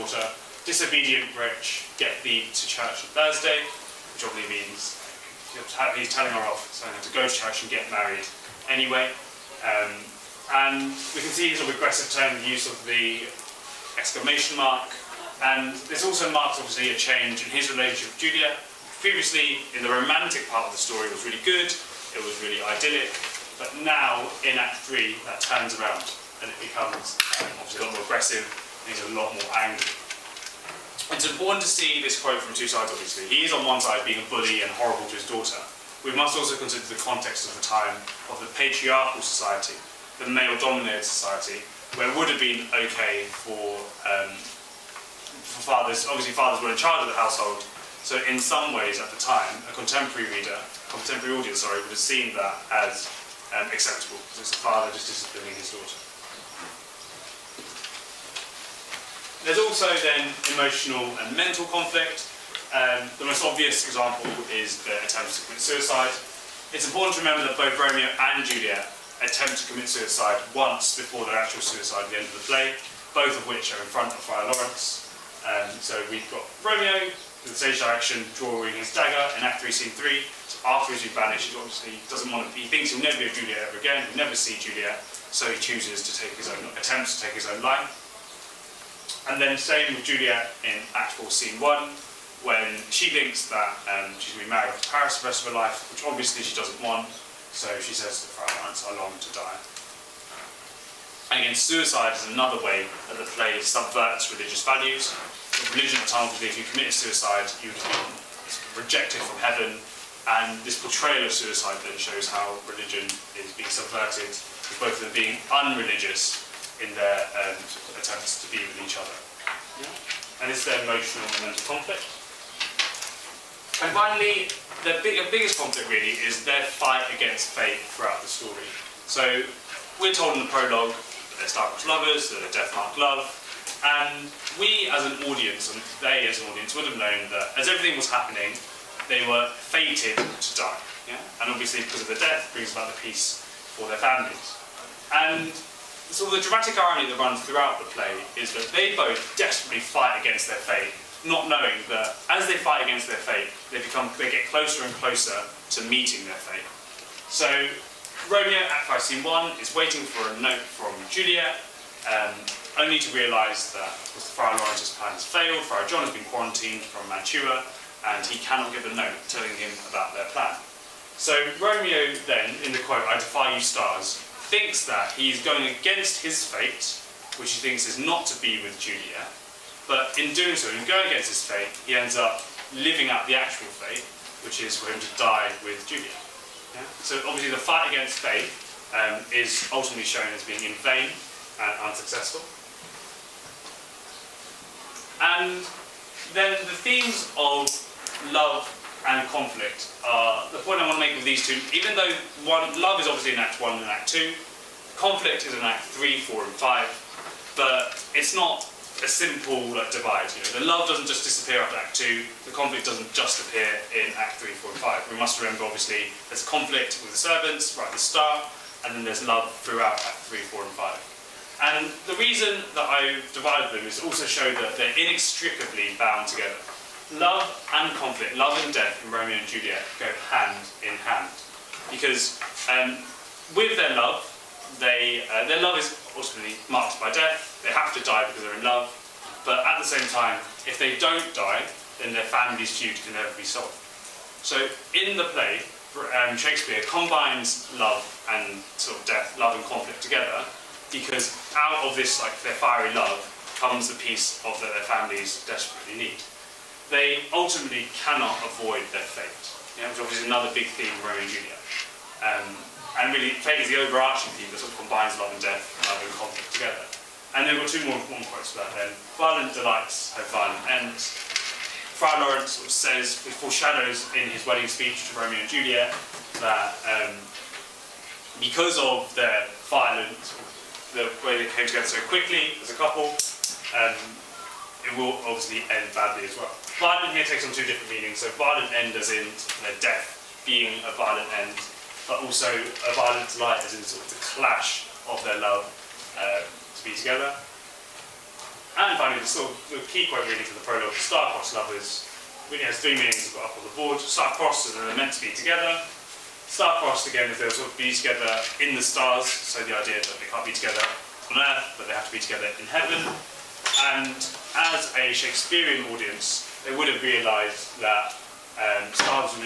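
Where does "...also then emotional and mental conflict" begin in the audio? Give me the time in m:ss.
0:59.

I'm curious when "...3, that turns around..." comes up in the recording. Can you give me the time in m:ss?
0:24.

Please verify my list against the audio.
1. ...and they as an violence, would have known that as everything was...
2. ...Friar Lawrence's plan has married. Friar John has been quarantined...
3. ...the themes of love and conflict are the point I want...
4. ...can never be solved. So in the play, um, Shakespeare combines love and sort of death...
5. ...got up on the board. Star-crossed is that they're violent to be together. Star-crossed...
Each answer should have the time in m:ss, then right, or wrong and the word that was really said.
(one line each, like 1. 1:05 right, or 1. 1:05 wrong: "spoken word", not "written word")
1. 2:15 wrong: "audience", not "violence"
2. 2:44 wrong: "failed", not "married"
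3. 3:16 right
4. 4:03 right
5. 5:03 wrong: "meant", not "violent".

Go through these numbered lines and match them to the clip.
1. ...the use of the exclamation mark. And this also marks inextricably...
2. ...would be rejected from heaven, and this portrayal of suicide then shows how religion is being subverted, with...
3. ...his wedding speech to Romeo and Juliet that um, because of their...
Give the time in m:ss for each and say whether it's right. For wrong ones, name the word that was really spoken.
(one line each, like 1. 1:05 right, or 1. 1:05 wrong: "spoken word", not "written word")
1. 0:12 wrong: "obviously", not "inextricably"
2. 1:47 right
3. 4:34 right.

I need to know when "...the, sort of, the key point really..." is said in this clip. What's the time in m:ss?
4:59.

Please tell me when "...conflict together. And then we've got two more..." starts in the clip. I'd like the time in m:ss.
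4:26.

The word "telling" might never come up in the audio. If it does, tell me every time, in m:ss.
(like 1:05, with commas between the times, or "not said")
0:06, 2:49.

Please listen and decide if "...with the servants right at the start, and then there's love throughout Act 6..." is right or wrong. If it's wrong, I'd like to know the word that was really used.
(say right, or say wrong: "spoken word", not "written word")
wrong: "3", not "6".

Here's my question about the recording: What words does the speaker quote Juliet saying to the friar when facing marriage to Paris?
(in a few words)
I long to die.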